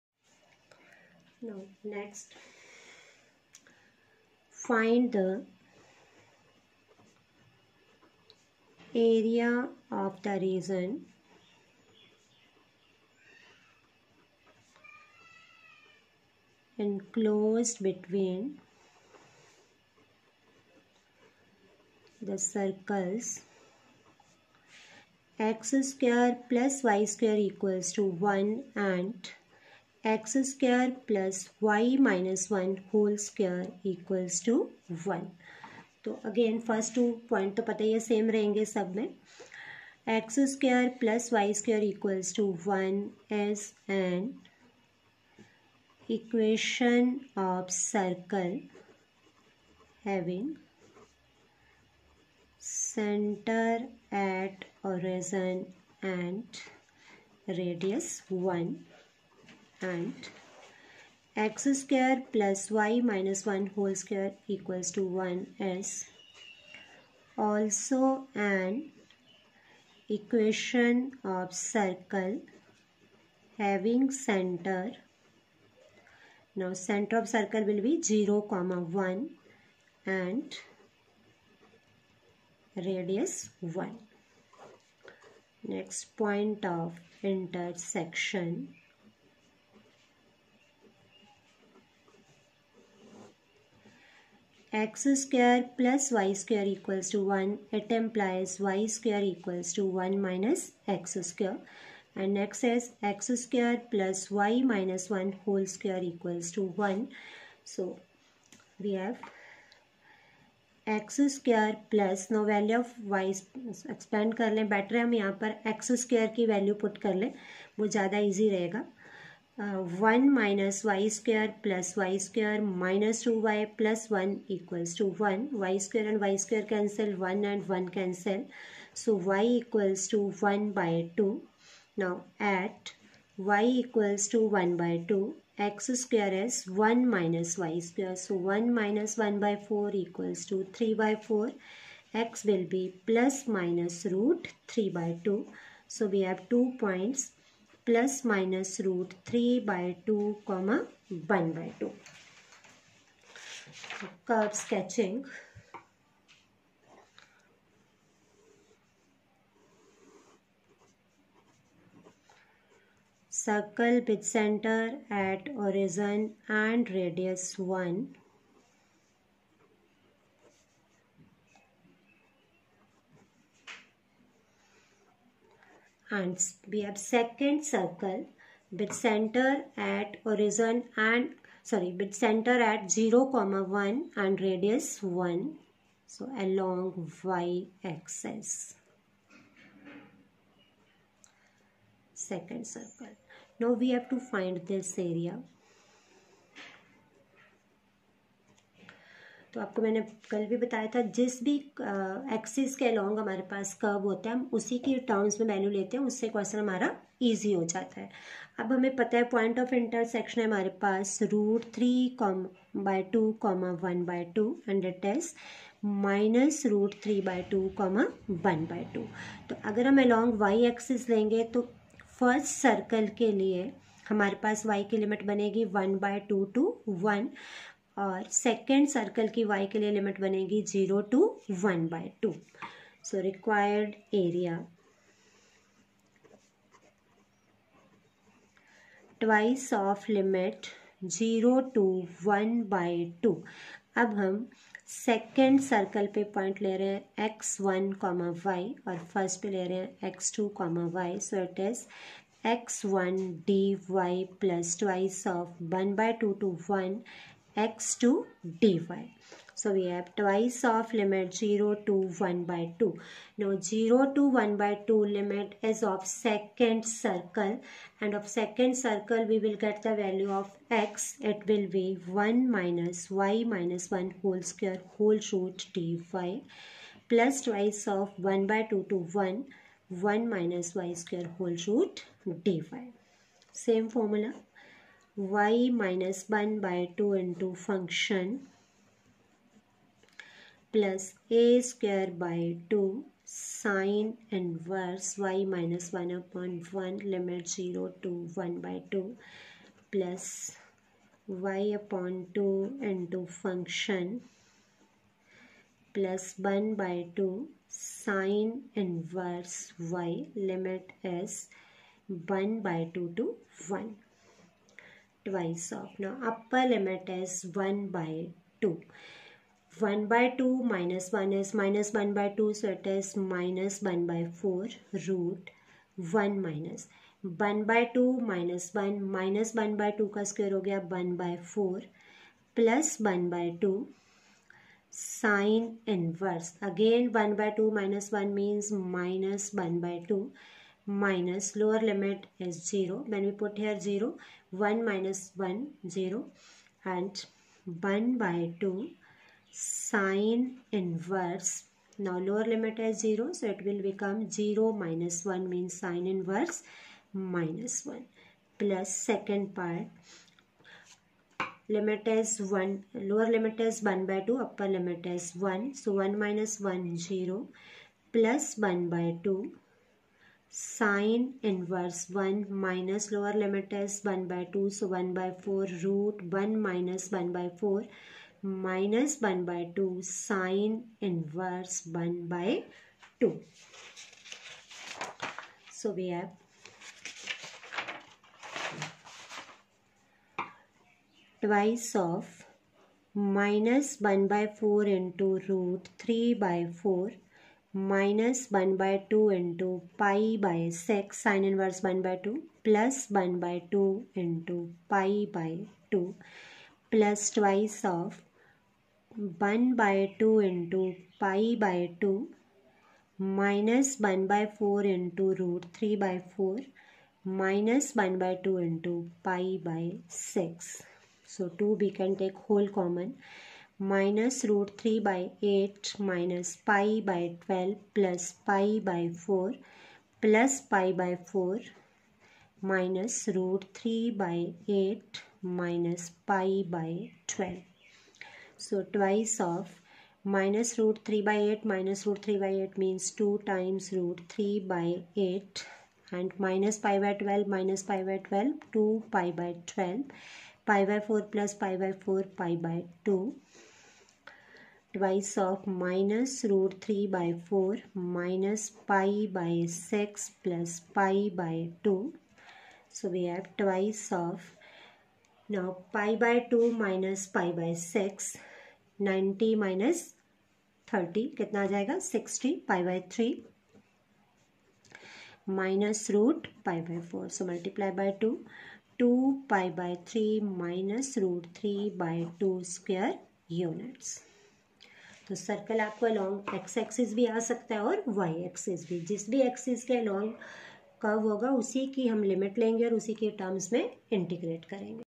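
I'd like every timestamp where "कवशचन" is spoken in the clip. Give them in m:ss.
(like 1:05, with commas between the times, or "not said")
3:26.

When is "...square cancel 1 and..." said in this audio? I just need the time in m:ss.
2:06.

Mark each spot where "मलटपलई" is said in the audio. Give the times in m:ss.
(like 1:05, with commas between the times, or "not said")
7:57.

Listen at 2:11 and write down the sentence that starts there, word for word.
Now at y equals to 1 by 2 x square is 1 minus y square.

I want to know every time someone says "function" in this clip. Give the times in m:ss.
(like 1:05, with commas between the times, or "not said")
4:47, 5:03.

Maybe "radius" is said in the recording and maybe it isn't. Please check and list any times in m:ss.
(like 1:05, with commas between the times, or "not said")
1:22, 3:04.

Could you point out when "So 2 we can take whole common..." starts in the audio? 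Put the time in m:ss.
7:01.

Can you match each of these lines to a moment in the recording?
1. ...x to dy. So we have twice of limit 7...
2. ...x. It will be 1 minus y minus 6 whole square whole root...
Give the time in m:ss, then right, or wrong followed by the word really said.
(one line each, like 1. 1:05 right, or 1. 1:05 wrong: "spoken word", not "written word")
1. 4:17 wrong: "0", not "7"
2. 4:30 wrong: "1", not "6".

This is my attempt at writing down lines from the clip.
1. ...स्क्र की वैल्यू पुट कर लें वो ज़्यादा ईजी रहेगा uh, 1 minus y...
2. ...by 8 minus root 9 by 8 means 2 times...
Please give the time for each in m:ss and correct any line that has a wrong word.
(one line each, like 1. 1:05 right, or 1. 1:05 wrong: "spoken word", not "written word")
1. 1:56 right
2. 7:21 wrong: "3", not "9".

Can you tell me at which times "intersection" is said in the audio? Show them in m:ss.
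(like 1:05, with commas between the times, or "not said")
1:27.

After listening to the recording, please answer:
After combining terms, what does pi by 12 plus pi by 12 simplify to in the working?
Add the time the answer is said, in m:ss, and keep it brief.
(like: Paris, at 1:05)
2 pi/12, at 7:28.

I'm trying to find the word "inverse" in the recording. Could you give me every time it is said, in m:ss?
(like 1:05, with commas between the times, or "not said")
4:54, 5:08, 5:50, 5:56, 6:11, 6:21, 6:41.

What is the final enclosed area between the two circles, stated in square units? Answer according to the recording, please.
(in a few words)
2pi/3 - root3/2.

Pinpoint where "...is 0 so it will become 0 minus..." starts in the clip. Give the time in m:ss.
5:52.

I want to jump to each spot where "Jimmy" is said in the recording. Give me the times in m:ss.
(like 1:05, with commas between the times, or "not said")
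not said.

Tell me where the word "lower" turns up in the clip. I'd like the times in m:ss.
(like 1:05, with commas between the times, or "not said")
5:41, 5:52, 6:03, 6:13.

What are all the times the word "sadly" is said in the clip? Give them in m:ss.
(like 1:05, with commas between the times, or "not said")
not said.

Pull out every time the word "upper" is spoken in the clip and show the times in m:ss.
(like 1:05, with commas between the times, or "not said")
5:16, 6:04.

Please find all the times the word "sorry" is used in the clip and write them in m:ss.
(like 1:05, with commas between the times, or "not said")
3:01.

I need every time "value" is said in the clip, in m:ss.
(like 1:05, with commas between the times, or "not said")
4:29.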